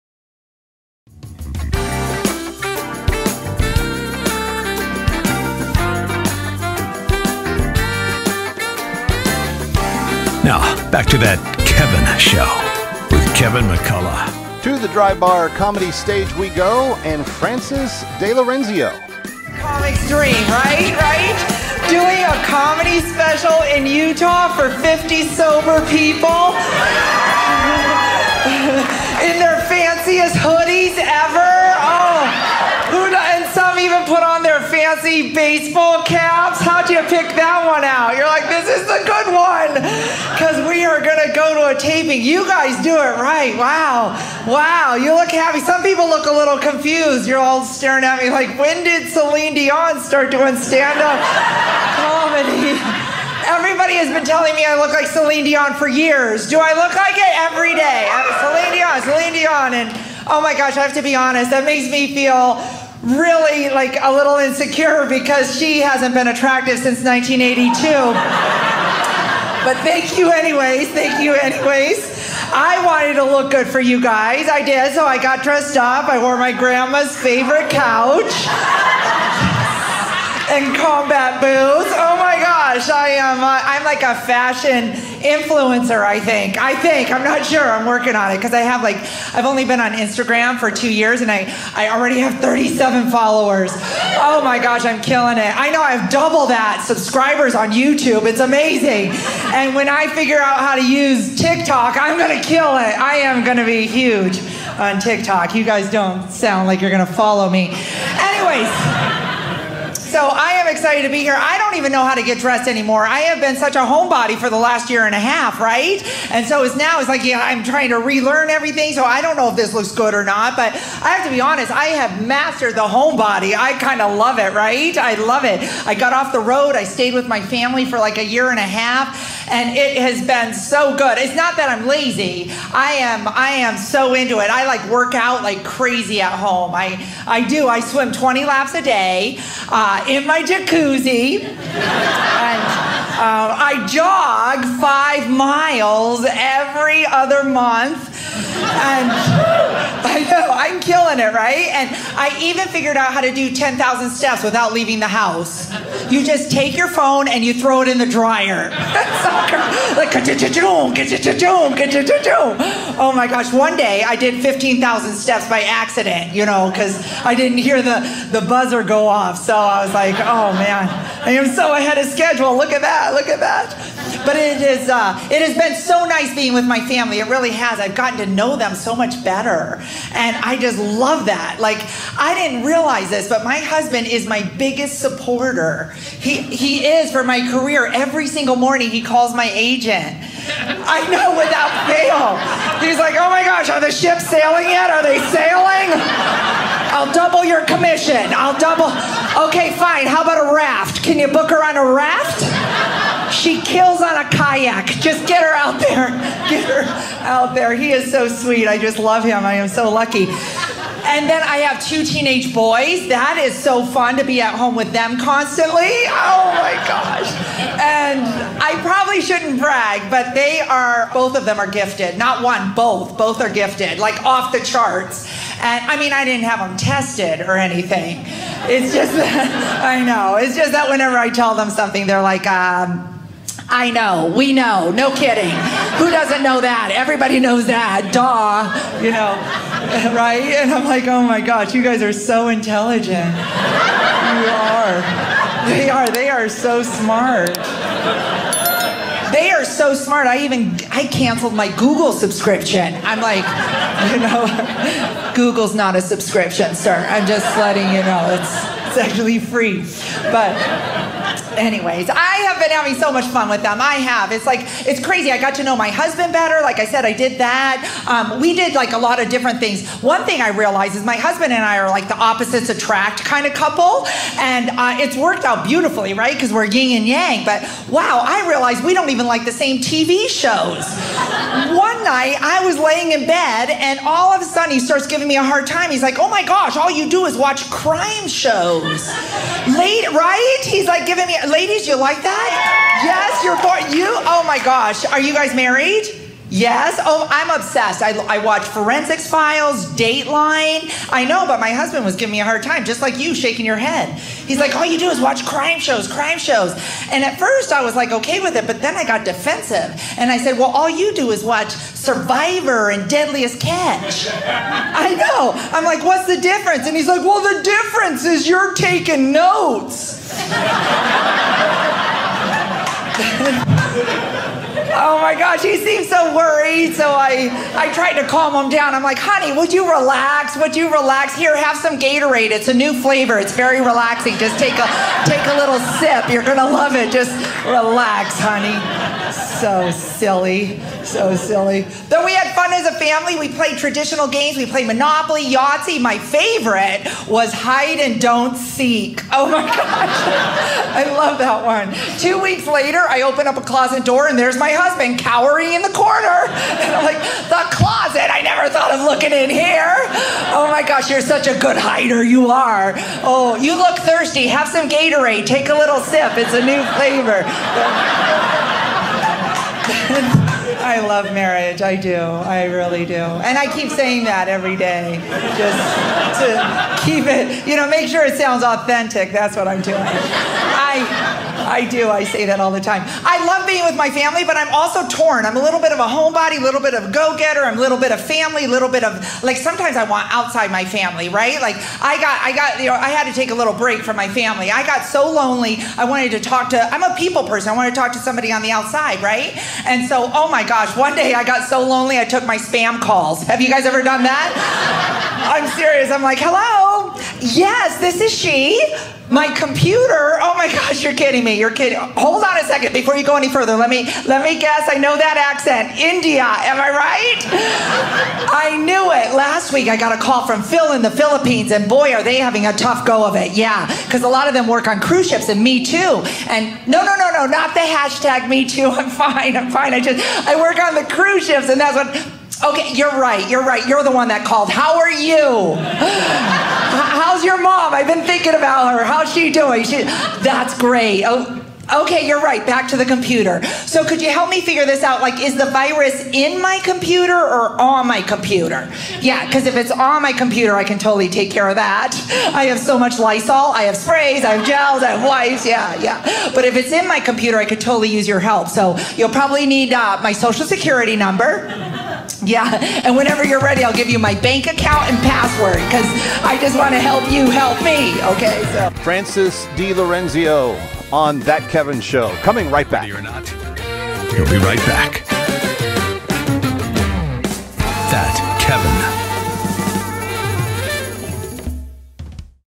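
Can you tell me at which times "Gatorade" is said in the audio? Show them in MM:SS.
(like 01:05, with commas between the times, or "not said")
05:31, 06:04.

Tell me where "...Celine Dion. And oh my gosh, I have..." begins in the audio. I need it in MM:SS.
00:59.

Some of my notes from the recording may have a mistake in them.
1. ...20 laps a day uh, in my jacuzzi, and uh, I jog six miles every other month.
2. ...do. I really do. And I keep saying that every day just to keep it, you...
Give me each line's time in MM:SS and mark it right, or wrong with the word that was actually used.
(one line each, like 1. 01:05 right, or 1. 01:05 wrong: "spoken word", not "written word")
1. 02:18 wrong: "five", not "six"
2. 06:11 right.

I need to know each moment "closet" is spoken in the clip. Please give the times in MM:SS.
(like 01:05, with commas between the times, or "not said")
05:53, 05:57.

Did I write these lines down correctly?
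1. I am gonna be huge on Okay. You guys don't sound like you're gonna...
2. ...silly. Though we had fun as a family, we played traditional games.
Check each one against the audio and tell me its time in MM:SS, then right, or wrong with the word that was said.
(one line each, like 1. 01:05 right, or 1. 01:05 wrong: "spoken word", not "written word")
1. 01:43 wrong: "TikTok", not "Okay"
2. 05:41 right.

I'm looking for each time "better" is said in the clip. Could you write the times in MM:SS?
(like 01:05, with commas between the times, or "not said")
02:59, 04:26.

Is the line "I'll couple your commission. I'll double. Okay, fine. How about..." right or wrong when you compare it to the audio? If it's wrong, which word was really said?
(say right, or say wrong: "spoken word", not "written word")
wrong: "double", not "couple".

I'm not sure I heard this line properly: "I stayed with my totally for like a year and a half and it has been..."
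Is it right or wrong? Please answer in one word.
wrong.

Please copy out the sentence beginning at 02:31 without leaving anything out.
And I even figured out how to do 10,000 steps without leaving the house.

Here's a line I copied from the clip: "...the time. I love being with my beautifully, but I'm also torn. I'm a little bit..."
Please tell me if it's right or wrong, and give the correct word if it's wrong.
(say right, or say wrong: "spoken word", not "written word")
wrong: "family", not "beautifully".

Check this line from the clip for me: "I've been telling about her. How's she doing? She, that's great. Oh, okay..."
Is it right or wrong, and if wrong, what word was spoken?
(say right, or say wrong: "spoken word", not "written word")
wrong: "thinking", not "telling".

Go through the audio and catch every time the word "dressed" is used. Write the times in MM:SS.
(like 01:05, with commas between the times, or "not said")
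01:15, 01:52.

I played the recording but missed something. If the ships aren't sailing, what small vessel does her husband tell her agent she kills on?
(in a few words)
kayak.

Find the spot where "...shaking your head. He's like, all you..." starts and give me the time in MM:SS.
05:03.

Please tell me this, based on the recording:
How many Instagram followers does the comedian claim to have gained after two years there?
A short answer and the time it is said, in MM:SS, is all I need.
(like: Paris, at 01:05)
37, at 01:32.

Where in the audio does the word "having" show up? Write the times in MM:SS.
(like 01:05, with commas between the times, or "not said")
04:22, 07:02.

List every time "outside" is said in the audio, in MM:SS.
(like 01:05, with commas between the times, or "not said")
06:30, 06:38.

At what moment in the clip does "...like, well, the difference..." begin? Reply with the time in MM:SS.
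05:17.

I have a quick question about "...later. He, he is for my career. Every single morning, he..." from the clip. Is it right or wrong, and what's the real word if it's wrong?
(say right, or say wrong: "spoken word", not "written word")
wrong: "supporter", not "later".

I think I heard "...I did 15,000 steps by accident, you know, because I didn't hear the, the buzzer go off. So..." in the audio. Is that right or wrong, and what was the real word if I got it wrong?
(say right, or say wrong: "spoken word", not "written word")
right.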